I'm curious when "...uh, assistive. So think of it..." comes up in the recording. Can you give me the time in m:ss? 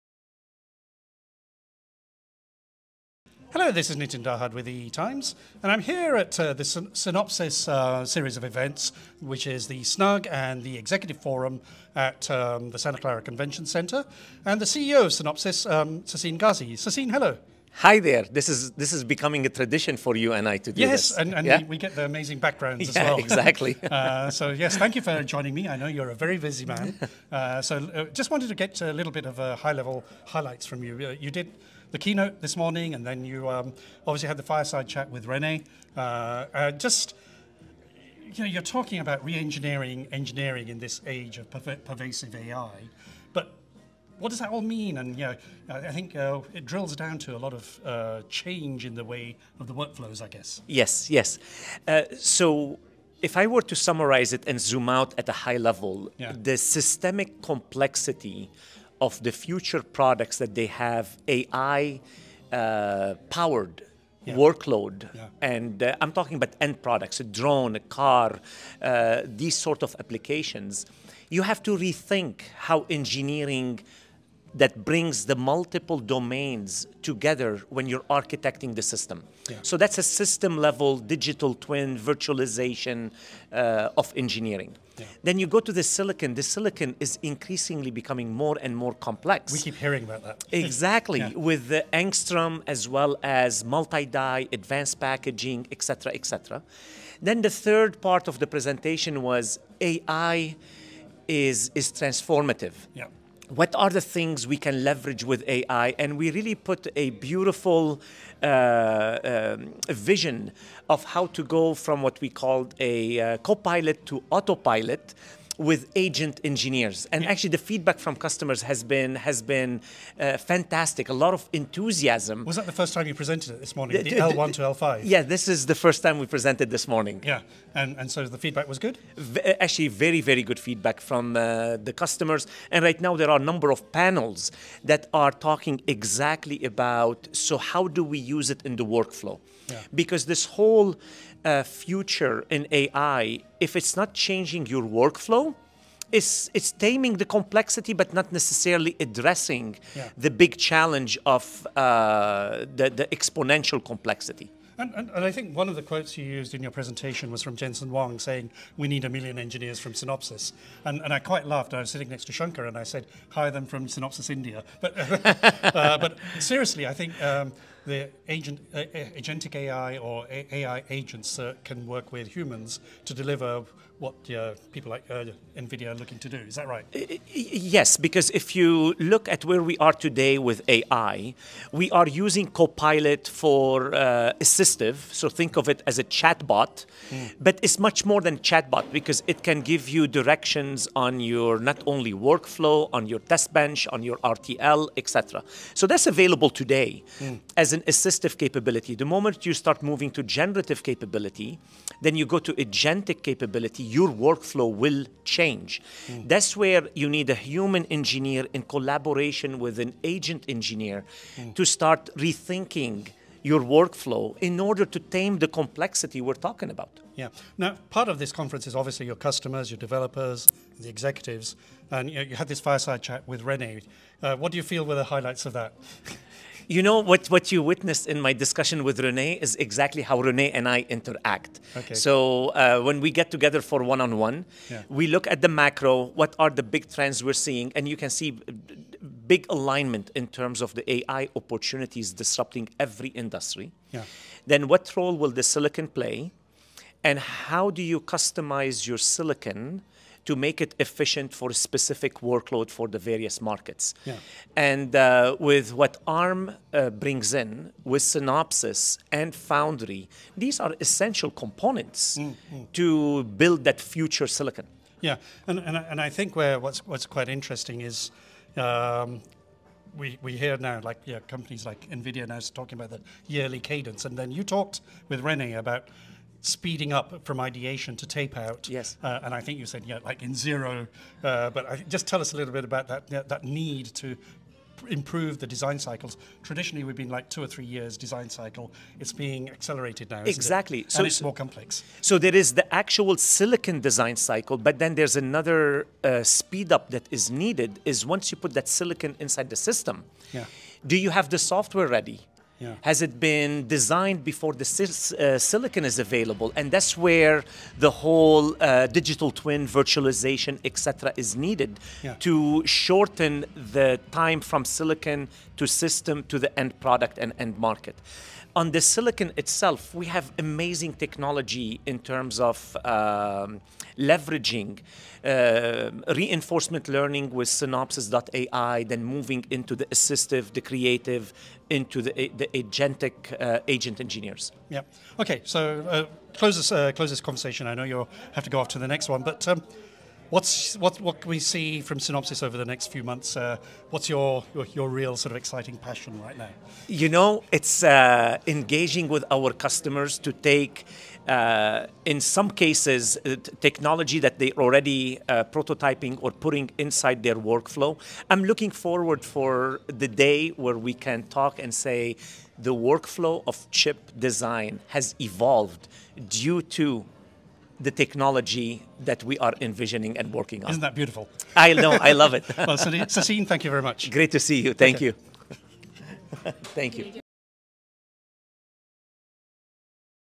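3:03.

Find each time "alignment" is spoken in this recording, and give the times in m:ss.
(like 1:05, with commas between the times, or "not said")
3:59.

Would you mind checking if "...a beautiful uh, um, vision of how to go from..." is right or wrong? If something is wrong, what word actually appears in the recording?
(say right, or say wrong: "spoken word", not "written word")
right.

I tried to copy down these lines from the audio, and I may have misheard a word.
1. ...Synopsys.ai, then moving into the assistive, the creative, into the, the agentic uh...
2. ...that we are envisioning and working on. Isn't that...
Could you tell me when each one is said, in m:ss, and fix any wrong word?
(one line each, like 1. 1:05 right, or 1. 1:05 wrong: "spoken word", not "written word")
1. 5:27 right
2. 6:09 right.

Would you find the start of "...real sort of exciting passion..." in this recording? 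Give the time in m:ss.
5:44.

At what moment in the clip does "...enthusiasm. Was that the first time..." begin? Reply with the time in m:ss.
2:01.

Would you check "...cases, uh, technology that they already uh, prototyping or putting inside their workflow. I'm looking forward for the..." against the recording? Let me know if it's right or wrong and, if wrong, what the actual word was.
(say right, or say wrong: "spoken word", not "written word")
right.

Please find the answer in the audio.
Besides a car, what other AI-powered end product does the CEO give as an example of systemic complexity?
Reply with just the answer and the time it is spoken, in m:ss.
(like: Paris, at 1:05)
A drone, at 1:07.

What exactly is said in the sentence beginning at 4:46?
Traditionally, we've been like two or three years design cycle.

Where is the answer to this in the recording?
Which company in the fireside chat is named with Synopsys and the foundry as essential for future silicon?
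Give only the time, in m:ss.
4:16.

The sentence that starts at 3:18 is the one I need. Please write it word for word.
The moment you start moving to generative capability, then you go to agentic capability your workflow will change.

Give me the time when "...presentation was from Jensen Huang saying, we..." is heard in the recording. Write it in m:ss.
2:36.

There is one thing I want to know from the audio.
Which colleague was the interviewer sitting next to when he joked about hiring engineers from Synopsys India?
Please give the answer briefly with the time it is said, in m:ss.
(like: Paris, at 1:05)
Shankar, at 2:42.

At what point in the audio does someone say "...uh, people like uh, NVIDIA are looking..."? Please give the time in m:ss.
2:54.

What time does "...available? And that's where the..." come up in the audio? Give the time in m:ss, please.
5:05.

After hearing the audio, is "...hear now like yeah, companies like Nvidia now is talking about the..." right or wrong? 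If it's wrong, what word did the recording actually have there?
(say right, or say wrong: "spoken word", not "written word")
right.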